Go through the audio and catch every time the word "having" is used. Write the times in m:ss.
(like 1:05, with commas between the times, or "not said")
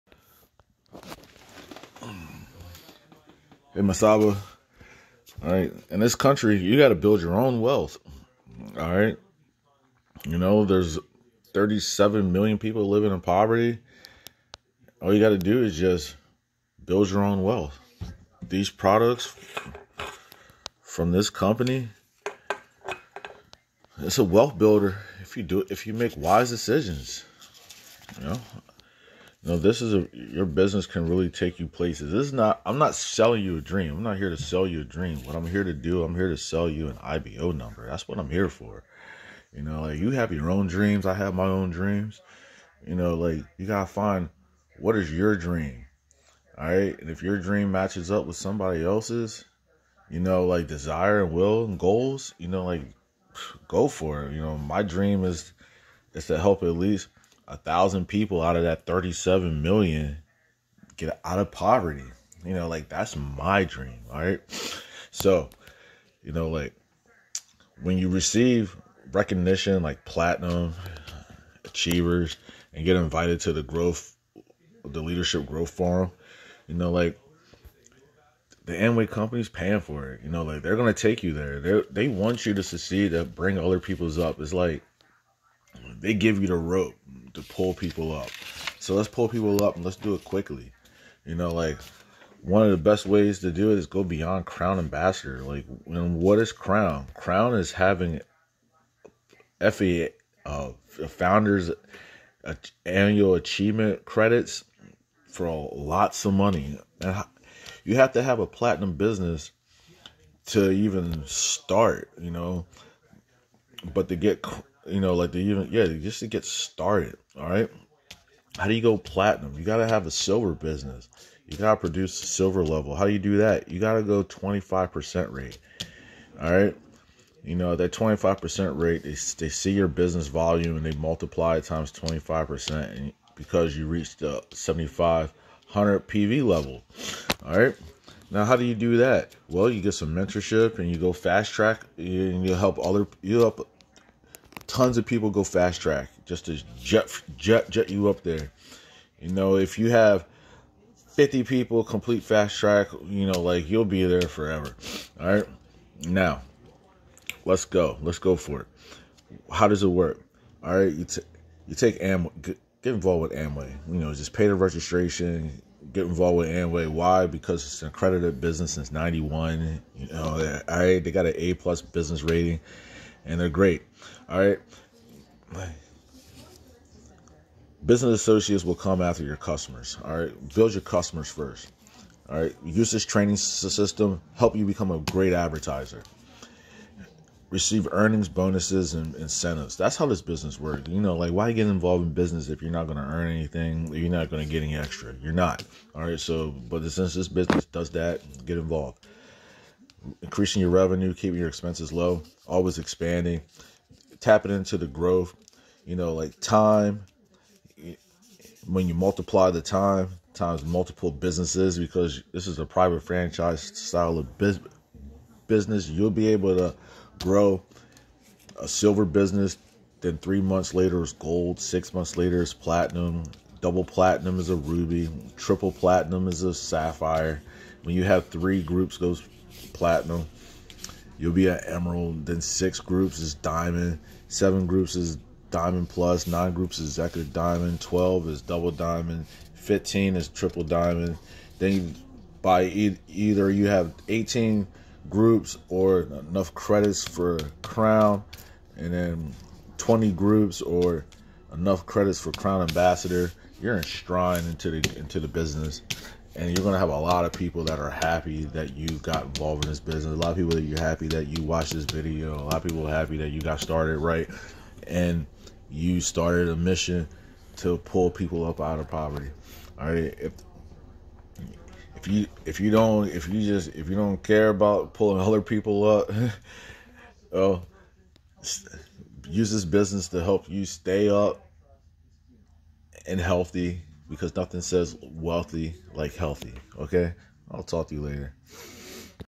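1:37.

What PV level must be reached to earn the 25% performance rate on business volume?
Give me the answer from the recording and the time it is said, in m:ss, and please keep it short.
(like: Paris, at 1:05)
7500, at 2:14.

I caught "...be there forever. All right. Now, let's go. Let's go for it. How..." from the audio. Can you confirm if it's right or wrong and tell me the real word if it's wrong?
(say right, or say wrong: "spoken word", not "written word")
right.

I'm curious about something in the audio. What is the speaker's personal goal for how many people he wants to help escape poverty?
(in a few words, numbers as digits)
1000.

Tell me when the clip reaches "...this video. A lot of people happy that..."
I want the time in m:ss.
4:21.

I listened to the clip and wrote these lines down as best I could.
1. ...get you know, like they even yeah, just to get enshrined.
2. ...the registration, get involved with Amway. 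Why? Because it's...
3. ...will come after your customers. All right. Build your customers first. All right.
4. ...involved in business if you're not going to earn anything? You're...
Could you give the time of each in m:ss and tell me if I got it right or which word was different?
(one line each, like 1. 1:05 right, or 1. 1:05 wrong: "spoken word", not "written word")
1. 1:54 wrong: "started", not "enshrined"
2. 2:44 right
3. 2:58 right
4. 3:11 right.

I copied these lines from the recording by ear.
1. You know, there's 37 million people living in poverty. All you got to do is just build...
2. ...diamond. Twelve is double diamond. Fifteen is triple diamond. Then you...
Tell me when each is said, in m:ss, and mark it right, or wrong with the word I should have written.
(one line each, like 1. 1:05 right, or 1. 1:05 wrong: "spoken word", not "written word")
1. 0:10 right
2. 3:57 right.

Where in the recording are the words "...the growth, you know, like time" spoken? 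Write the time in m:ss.
3:24.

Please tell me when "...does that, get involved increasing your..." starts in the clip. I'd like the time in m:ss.
3:17.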